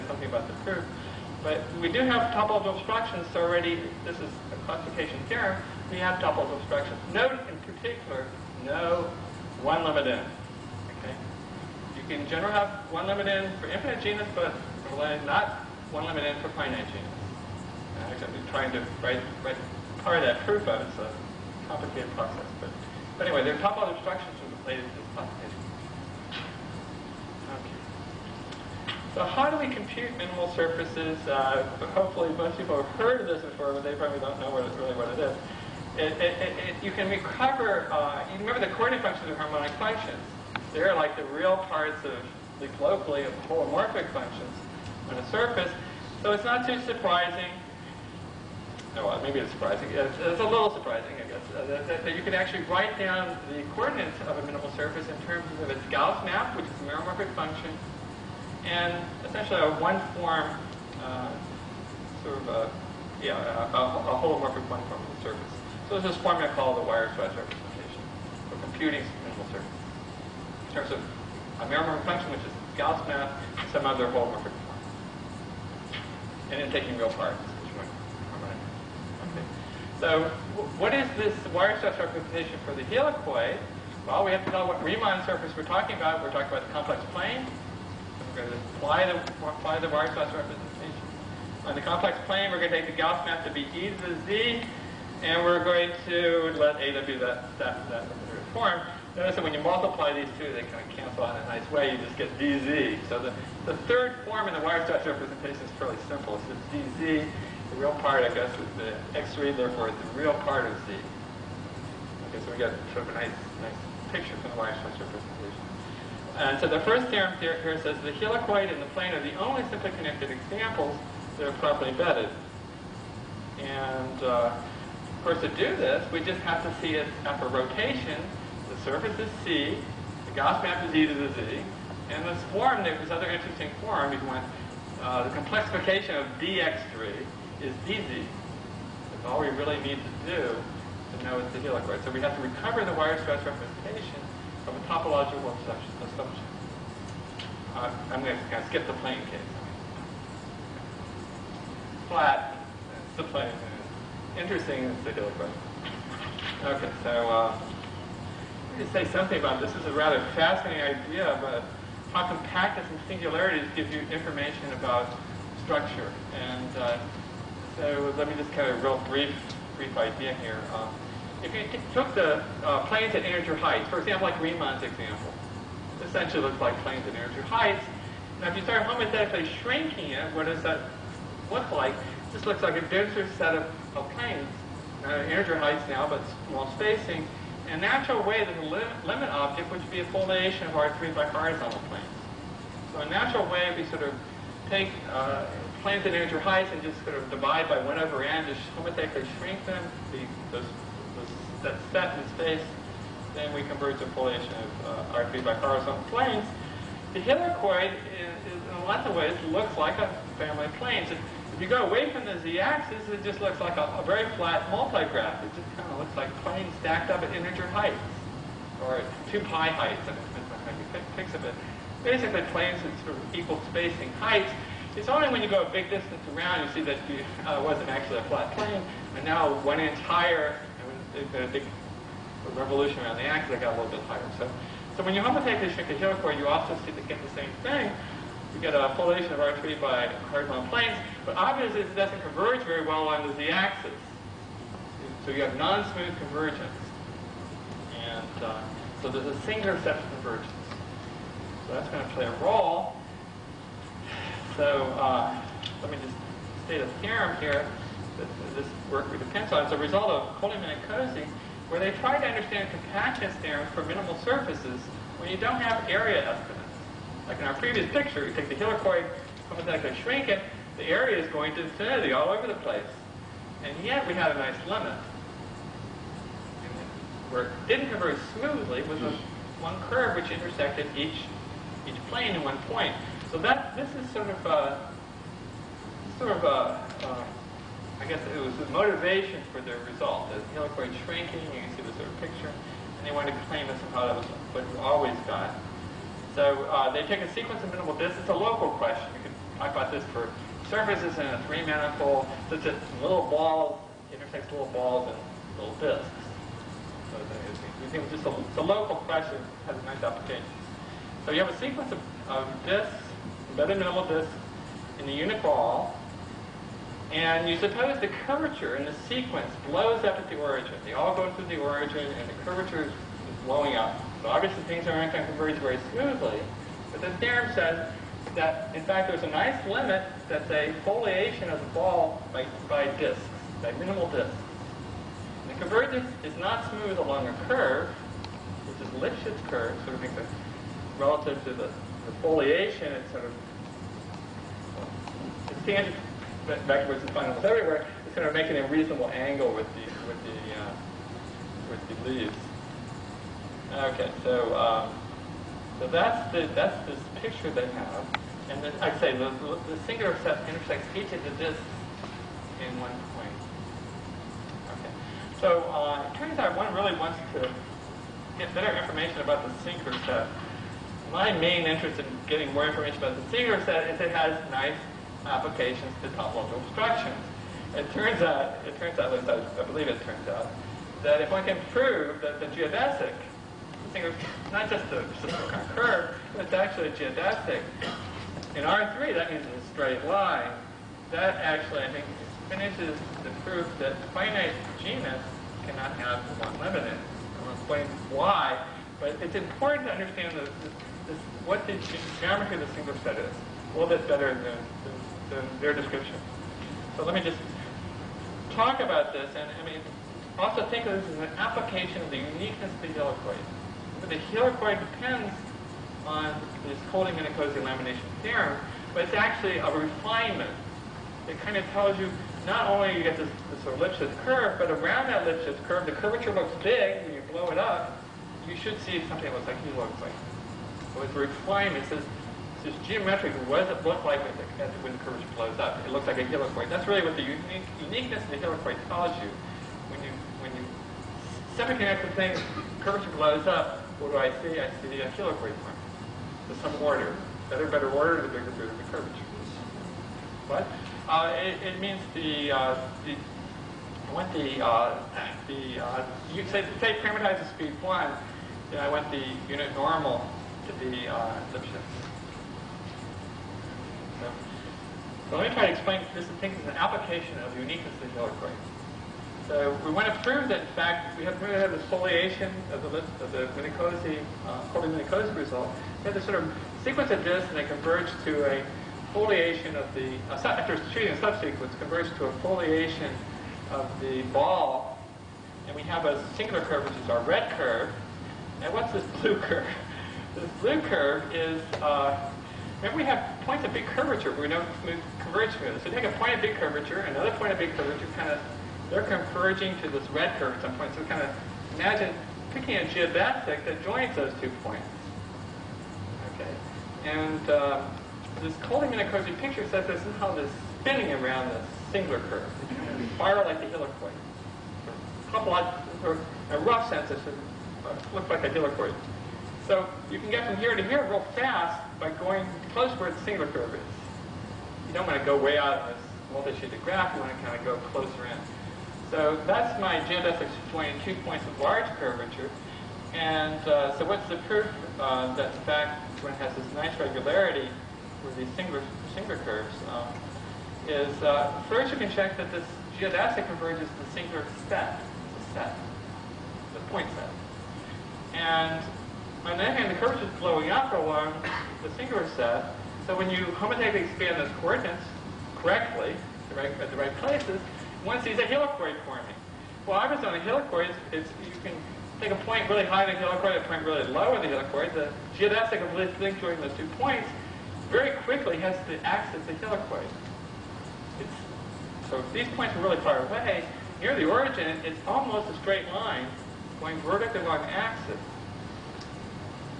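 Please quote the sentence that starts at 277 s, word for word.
Where it didn't converge very smoothly was a, one curve which intersected each each plane in one point.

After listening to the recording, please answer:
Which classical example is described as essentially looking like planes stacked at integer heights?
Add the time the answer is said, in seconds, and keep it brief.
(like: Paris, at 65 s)
Riemann's example, at 174 s.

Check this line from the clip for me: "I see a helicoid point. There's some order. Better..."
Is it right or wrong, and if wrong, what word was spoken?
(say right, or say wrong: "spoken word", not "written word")
right.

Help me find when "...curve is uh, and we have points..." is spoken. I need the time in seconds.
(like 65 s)
490 s.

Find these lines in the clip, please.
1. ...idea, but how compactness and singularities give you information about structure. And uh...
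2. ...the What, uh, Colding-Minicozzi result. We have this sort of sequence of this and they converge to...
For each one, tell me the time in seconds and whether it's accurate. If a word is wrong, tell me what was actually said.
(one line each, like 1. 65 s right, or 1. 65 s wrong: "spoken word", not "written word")
1. 160 s right
2. 473 s wrong: "Minicozzi", not "What".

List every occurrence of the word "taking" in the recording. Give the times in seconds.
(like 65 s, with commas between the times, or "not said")
76 s.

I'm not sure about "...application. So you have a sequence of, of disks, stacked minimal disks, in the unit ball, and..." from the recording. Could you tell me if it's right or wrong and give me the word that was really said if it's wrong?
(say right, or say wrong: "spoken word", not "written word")
wrong: "embedded", not "stacked".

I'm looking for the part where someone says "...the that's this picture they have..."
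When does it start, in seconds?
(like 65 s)
356 s.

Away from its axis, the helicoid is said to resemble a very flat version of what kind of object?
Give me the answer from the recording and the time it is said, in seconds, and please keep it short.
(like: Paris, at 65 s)
multigraph, at 214 s.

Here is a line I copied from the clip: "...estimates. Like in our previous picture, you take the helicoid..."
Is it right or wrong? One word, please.
right.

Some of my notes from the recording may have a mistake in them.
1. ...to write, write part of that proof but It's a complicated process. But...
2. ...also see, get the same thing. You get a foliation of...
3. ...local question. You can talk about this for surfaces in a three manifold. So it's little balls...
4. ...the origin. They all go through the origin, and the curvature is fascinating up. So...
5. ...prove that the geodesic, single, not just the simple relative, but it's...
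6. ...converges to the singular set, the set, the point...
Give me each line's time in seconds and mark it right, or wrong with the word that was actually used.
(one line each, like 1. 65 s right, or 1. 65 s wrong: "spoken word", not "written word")
1. 18 s right
2. 236 s right
3. 298 s right
4. 320 s wrong: "blowing", not "fascinating"
5. 381 s wrong: "curve", not "relative"
6. 543 s right.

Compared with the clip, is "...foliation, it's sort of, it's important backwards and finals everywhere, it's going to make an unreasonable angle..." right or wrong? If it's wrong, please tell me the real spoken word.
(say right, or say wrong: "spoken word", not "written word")
wrong: "tangent", not "important".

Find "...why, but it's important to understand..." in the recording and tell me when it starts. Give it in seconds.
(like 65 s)
398 s.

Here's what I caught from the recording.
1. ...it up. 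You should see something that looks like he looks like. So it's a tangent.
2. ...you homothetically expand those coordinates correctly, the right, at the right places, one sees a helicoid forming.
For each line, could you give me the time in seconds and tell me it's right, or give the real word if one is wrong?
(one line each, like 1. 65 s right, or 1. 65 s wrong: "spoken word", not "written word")
1. 427 s wrong: "refinement", not "tangent"
2. 553 s right.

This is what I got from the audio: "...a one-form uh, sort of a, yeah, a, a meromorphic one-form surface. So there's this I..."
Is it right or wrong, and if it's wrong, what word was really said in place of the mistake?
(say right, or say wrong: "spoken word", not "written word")
wrong: "holomorphic", not "meromorphic".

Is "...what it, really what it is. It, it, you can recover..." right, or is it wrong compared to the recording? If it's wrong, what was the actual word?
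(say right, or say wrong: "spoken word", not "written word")
right.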